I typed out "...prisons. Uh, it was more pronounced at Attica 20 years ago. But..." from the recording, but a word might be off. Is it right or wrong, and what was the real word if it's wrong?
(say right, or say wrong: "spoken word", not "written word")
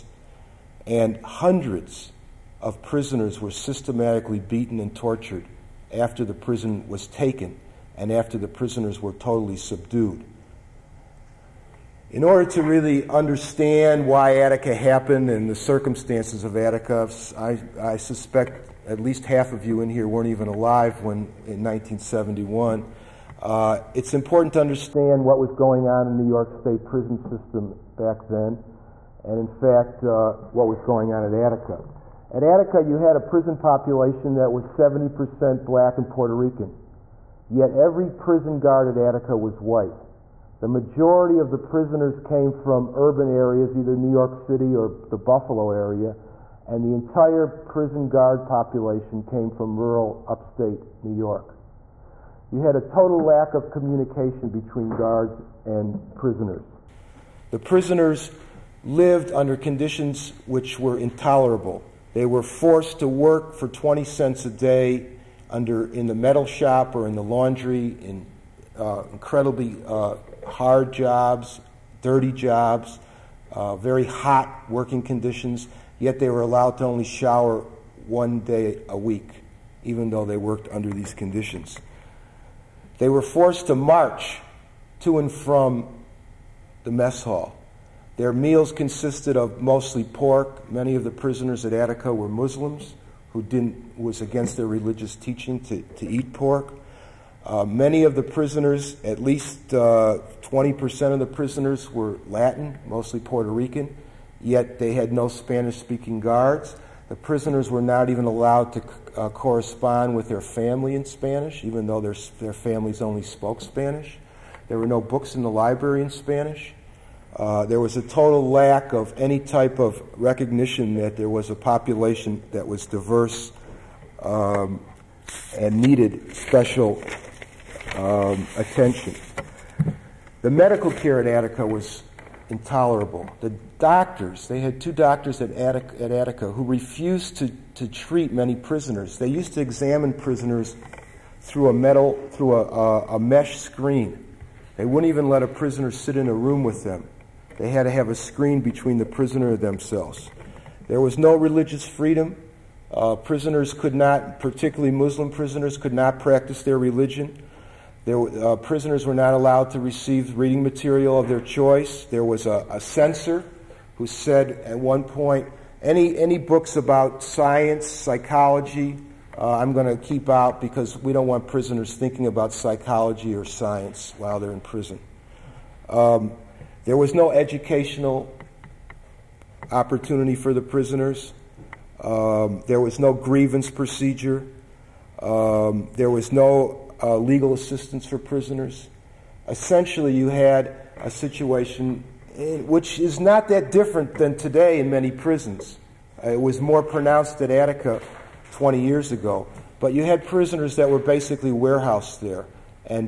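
right.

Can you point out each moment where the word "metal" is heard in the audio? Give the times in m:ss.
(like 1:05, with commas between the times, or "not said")
1:06, 2:21.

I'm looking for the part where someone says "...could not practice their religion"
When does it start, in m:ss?
2:35.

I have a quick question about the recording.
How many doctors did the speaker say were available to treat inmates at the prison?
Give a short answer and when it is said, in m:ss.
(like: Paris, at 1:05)
2, at 2:14.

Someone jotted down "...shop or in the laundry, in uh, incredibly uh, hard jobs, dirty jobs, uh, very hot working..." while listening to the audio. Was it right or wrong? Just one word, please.
right.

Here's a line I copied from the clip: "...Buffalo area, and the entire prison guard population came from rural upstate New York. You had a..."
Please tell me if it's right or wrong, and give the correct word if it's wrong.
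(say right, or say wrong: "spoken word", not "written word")
right.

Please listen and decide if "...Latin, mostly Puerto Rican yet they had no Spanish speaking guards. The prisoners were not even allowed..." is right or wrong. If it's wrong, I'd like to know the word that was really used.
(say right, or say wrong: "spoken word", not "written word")
right.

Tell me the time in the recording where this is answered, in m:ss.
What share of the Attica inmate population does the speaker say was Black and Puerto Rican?
0:34.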